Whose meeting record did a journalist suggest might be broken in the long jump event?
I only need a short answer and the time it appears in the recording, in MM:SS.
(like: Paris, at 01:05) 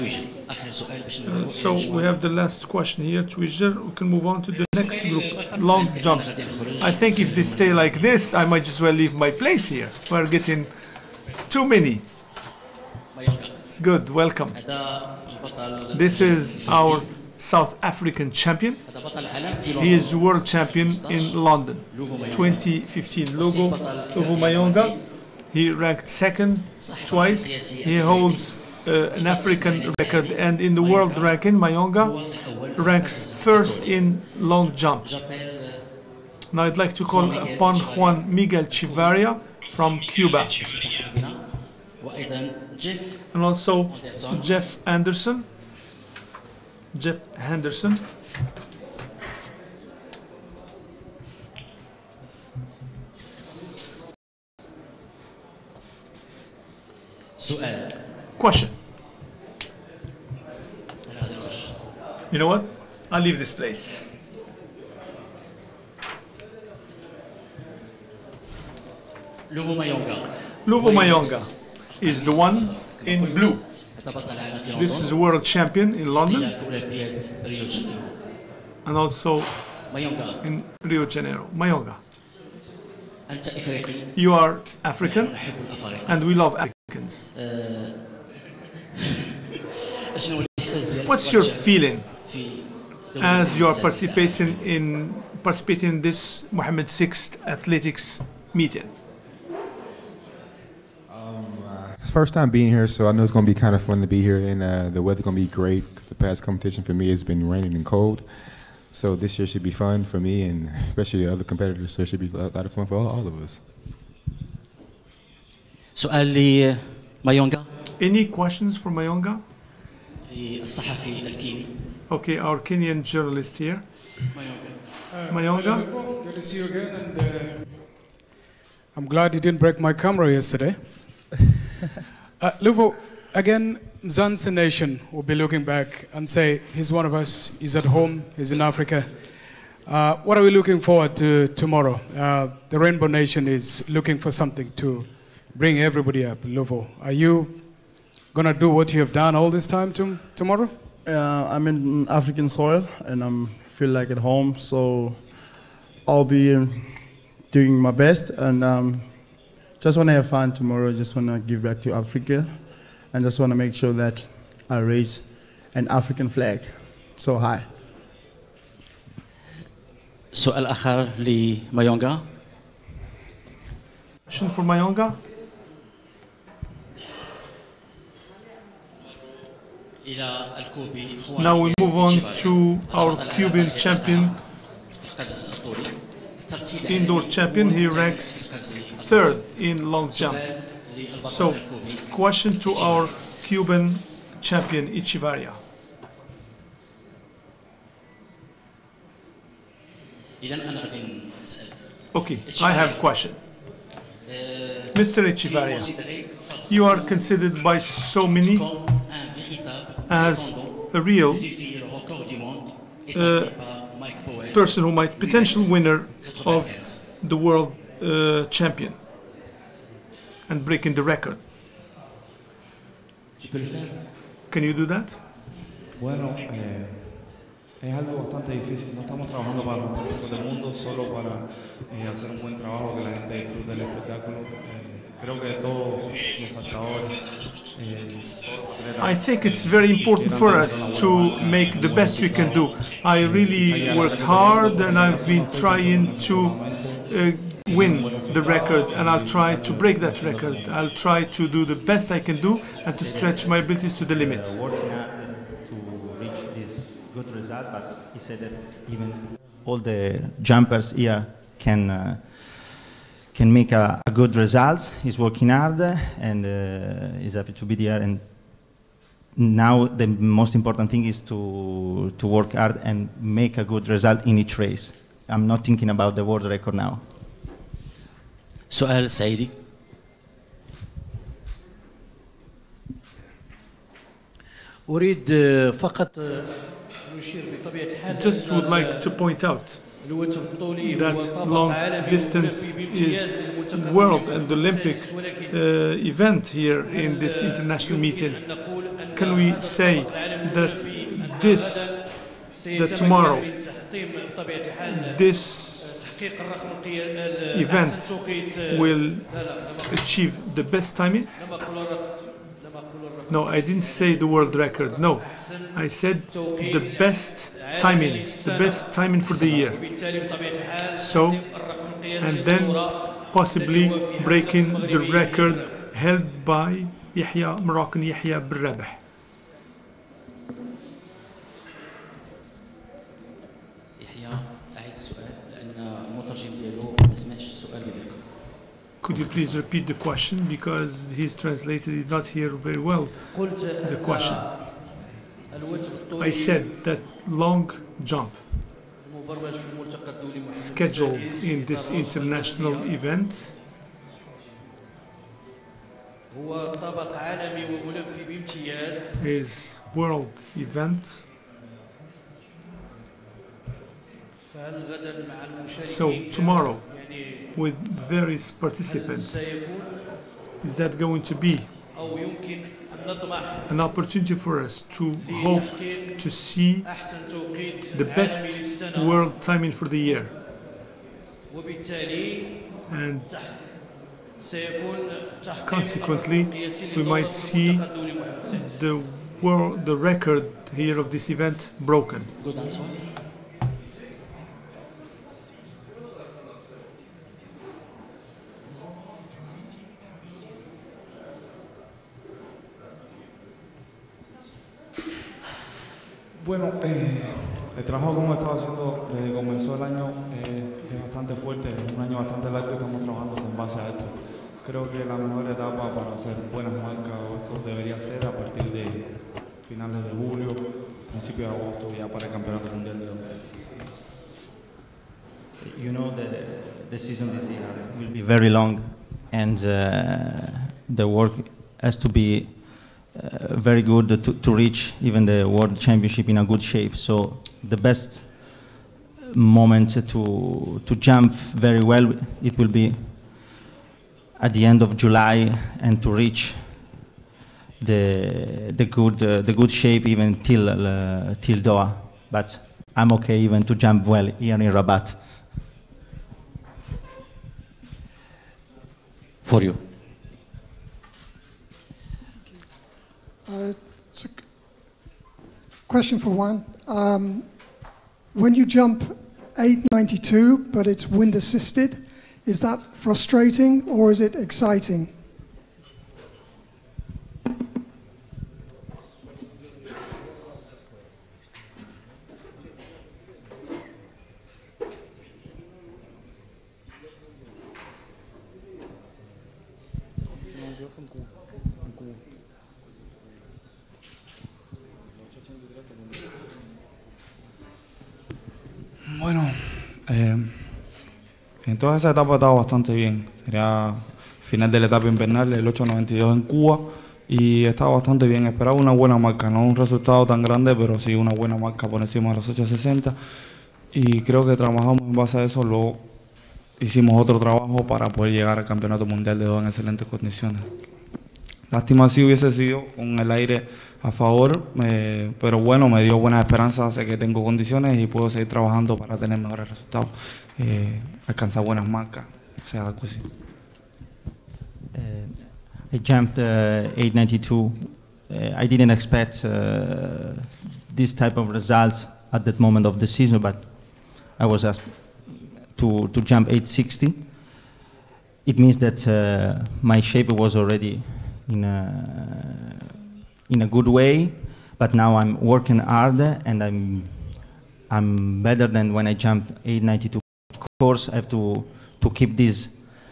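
Yahya Berrabah, at 05:27.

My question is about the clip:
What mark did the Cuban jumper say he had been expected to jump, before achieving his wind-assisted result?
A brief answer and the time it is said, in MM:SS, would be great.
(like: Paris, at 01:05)
860, at 09:06.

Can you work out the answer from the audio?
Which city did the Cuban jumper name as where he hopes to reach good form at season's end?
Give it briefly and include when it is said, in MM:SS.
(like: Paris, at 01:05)
Doha, at 07:31.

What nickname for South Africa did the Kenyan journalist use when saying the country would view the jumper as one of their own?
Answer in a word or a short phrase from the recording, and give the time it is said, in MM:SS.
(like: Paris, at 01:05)
Mzansi Nation, at 02:14.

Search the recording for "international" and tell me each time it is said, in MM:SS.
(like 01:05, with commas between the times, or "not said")
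04:57, 05:51.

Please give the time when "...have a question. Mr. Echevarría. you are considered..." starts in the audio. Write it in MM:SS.
03:22.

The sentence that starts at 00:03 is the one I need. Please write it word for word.
We can move on to the next group, long jumps.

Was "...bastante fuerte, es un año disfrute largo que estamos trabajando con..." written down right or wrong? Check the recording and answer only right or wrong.
wrong.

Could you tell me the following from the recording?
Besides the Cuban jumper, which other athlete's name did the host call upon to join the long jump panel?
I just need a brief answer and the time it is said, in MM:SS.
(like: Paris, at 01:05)
Jeff Henderson, at 00:43.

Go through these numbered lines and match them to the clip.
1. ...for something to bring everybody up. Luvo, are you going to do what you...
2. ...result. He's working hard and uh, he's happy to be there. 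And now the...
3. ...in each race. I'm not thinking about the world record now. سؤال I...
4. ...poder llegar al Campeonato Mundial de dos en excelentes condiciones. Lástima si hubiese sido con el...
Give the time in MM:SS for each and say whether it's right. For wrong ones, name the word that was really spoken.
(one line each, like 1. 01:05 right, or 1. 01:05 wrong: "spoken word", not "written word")
1. 02:24 right
2. 04:24 right
3. 04:34 right
4. 08:38 right.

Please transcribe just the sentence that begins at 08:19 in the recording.
Bueno, eh, en etapa esas estado bastante bien.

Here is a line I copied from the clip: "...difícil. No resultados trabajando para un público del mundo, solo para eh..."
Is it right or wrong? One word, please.
wrong.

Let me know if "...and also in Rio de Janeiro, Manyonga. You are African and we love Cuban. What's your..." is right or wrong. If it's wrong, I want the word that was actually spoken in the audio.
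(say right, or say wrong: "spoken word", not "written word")
wrong: "Africans", not "Cuban".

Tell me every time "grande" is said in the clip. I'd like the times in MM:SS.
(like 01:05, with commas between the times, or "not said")
08:30.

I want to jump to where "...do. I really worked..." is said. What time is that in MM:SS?
04:02.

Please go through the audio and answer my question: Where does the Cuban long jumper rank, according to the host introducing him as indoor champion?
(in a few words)
third.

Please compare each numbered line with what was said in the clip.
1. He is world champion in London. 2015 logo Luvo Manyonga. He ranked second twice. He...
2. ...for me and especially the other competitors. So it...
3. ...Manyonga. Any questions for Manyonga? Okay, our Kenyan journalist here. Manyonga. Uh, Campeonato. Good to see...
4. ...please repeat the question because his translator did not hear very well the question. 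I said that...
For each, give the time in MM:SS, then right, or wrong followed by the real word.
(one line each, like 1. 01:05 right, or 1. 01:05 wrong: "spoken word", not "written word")
1. 00:19 right
2. 01:50 right
3. 01:57 wrong: "Manyonga", not "Campeonato"
4. 05:39 right.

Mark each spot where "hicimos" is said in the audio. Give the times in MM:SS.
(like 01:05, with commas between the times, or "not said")
08:36.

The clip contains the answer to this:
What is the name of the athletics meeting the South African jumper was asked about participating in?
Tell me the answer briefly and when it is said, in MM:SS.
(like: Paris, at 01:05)
Mohammed VI athletics meeting, at 01:36.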